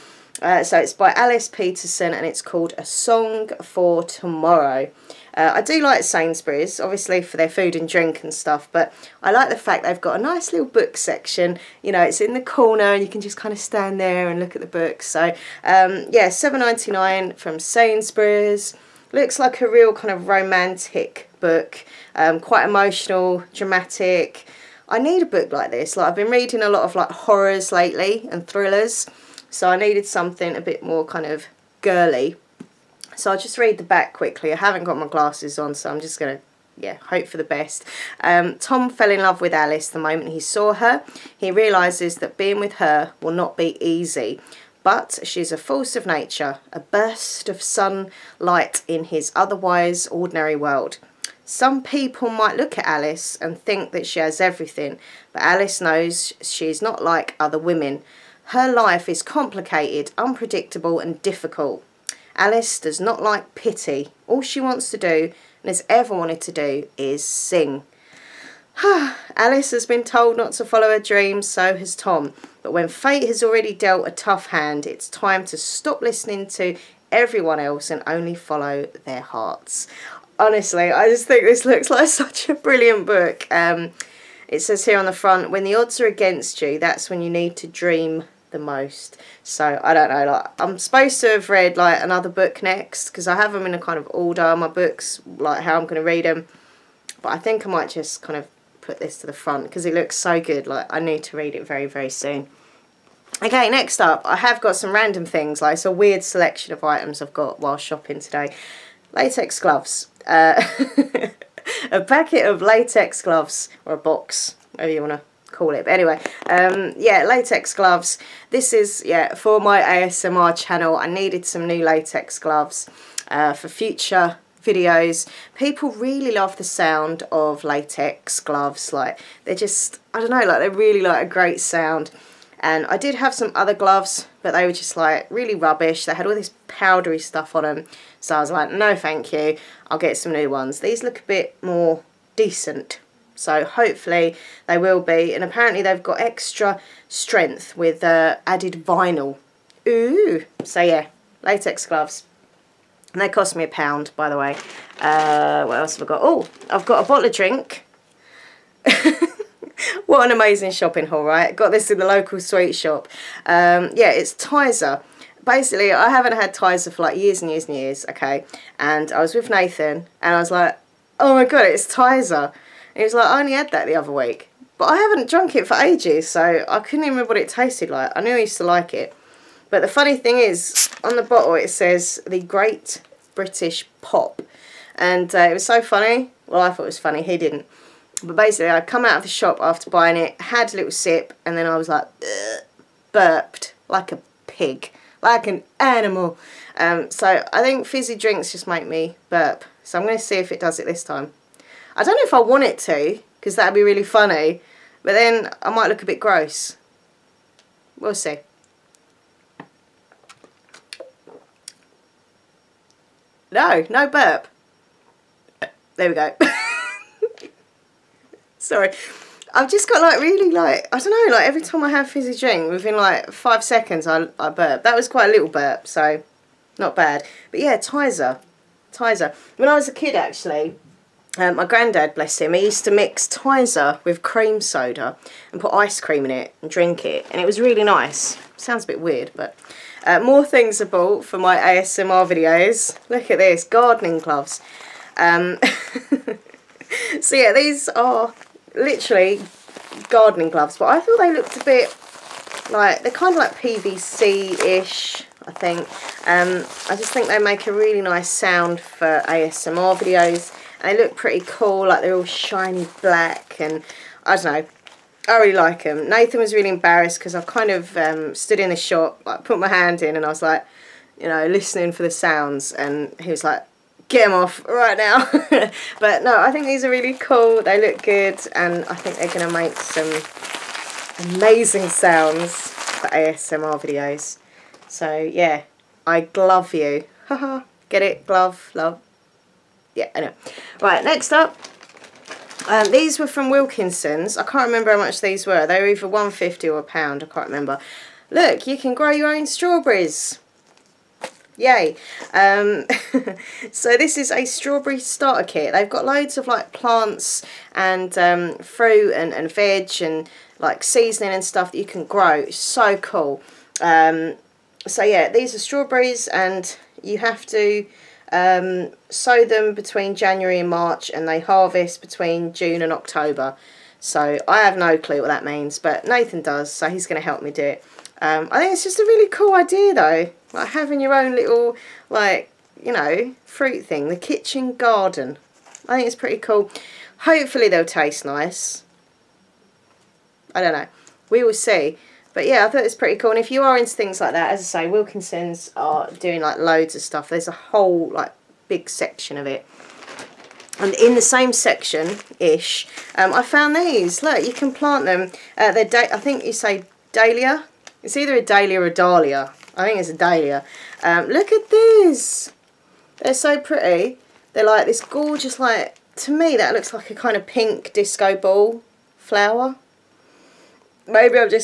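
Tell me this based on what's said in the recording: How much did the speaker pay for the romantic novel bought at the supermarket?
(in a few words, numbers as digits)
7.99.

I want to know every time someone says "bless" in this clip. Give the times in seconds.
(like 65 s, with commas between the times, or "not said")
232 s.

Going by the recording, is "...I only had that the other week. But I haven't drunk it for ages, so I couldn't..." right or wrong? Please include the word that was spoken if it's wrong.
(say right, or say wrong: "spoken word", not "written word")
right.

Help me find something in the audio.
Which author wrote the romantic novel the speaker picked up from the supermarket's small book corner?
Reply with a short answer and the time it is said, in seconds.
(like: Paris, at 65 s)
Alice Peterson, at 1 s.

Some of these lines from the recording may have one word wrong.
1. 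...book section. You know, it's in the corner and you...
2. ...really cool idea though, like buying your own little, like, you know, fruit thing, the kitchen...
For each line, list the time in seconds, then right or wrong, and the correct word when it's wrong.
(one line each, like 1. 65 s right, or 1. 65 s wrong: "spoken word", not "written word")
1. 10 s right
2. 329 s wrong: "having", not "buying".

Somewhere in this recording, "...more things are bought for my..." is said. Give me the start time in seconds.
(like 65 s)
240 s.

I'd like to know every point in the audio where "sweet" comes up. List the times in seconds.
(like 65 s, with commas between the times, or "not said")
162 s.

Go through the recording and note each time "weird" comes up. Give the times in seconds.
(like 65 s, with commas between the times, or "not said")
105 s, 239 s.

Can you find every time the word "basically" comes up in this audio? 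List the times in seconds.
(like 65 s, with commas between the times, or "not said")
165 s, 188 s.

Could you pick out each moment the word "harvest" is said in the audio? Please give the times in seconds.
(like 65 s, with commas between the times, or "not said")
321 s.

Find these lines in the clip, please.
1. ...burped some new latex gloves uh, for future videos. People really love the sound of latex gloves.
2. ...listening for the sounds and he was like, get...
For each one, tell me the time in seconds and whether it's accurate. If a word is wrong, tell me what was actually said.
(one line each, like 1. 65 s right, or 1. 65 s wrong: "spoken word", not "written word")
1. 121 s wrong: "needed", not "burped"
2. 271 s right.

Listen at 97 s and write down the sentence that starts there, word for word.
But I think I might just kind of put this to the front because it looks so good.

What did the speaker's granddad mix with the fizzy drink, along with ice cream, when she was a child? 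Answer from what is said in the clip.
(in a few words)
Cream soda.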